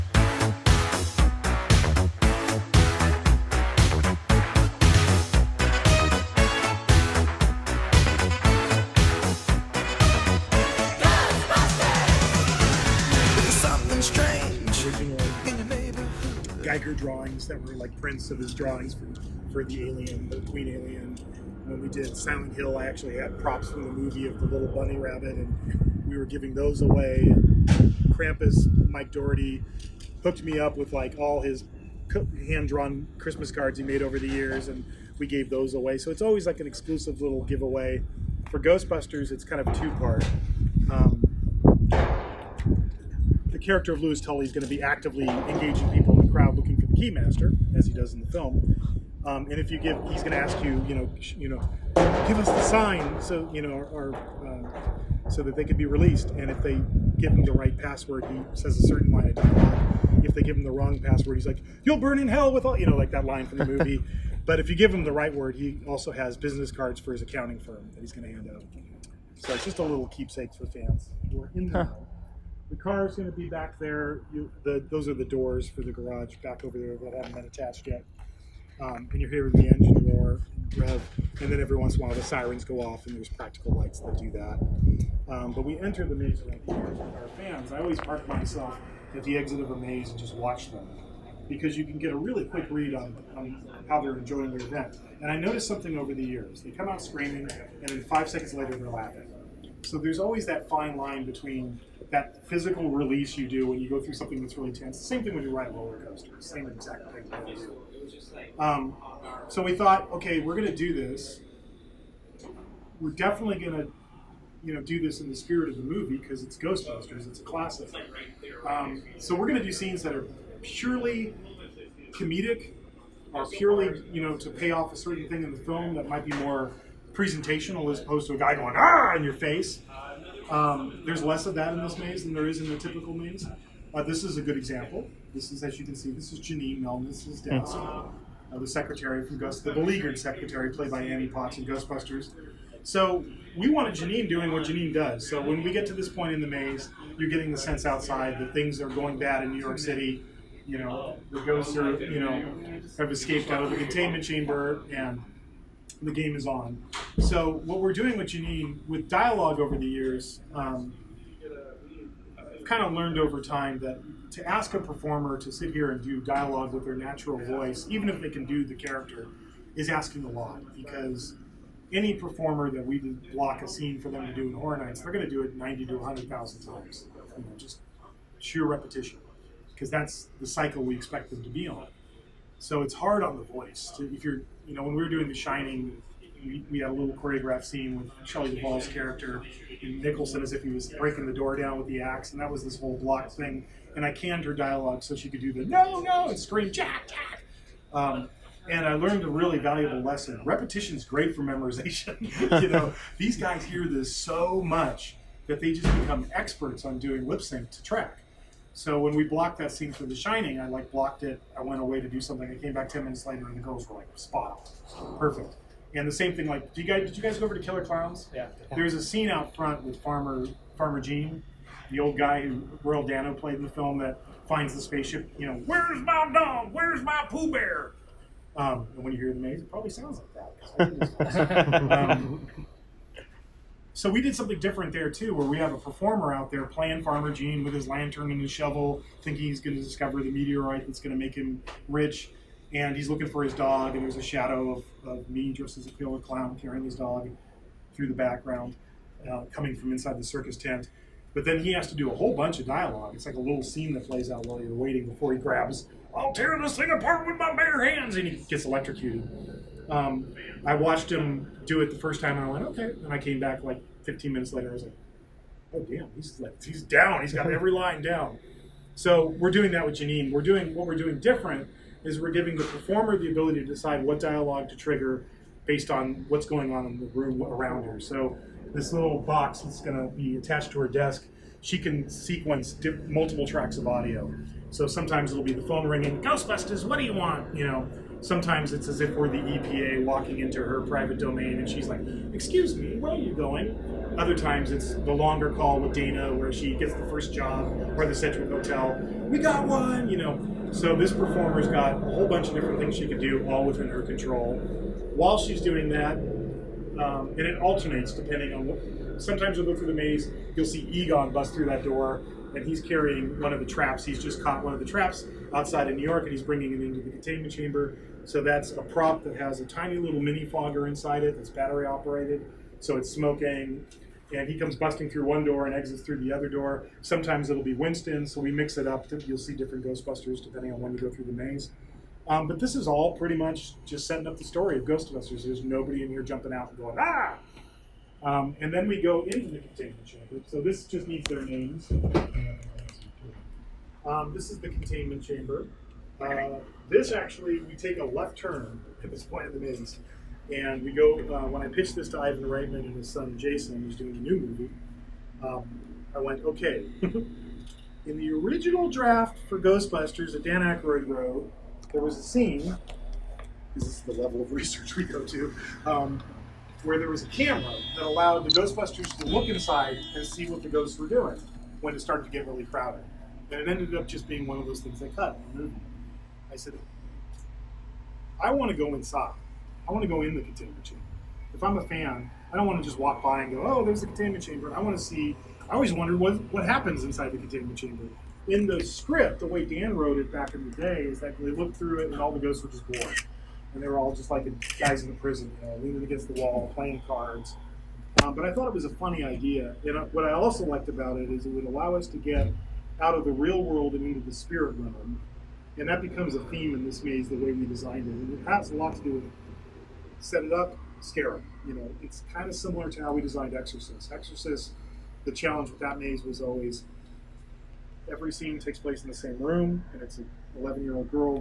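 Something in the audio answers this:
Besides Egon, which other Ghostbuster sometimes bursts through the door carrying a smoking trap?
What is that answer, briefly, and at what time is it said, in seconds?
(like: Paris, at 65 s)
Winston, at 327 s.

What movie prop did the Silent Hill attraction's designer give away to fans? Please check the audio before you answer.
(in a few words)
little bunny rabbit.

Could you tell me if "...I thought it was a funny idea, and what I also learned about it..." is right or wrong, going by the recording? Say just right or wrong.
wrong.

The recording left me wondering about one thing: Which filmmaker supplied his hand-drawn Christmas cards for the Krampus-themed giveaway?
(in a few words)
Mike Dougherty.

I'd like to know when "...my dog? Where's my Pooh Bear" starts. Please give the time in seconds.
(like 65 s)
226 s.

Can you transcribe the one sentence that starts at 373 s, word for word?
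And it ended up just being one of those things they cut in the movie.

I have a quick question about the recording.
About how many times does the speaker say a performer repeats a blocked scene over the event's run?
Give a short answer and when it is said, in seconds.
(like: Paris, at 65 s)
90 to 100,000, at 175 s.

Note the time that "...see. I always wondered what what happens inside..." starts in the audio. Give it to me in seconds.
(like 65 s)
385 s.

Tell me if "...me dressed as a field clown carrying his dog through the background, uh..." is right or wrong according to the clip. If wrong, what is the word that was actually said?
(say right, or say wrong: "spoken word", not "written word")
right.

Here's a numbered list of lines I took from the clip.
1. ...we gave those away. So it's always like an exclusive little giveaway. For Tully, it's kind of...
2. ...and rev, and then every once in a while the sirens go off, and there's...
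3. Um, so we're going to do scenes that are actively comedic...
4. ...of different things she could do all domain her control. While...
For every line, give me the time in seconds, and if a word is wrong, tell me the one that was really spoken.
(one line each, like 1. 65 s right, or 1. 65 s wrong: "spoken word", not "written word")
1. 35 s wrong: "Ghostbusters", not "Tully"
2. 80 s right
3. 118 s wrong: "purely", not "actively"
4. 302 s wrong: "within", not "domain".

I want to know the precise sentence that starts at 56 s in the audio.
And if they give him the right password, he says a certain line of dialogue.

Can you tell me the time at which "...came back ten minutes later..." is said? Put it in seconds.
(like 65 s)
212 s.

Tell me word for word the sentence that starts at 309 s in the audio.
Sometimes you'll go through the maze, you'll see Egon bust through that door, and he's carrying one of the traps.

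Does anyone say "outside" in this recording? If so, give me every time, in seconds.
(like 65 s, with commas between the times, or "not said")
147 s, 315 s.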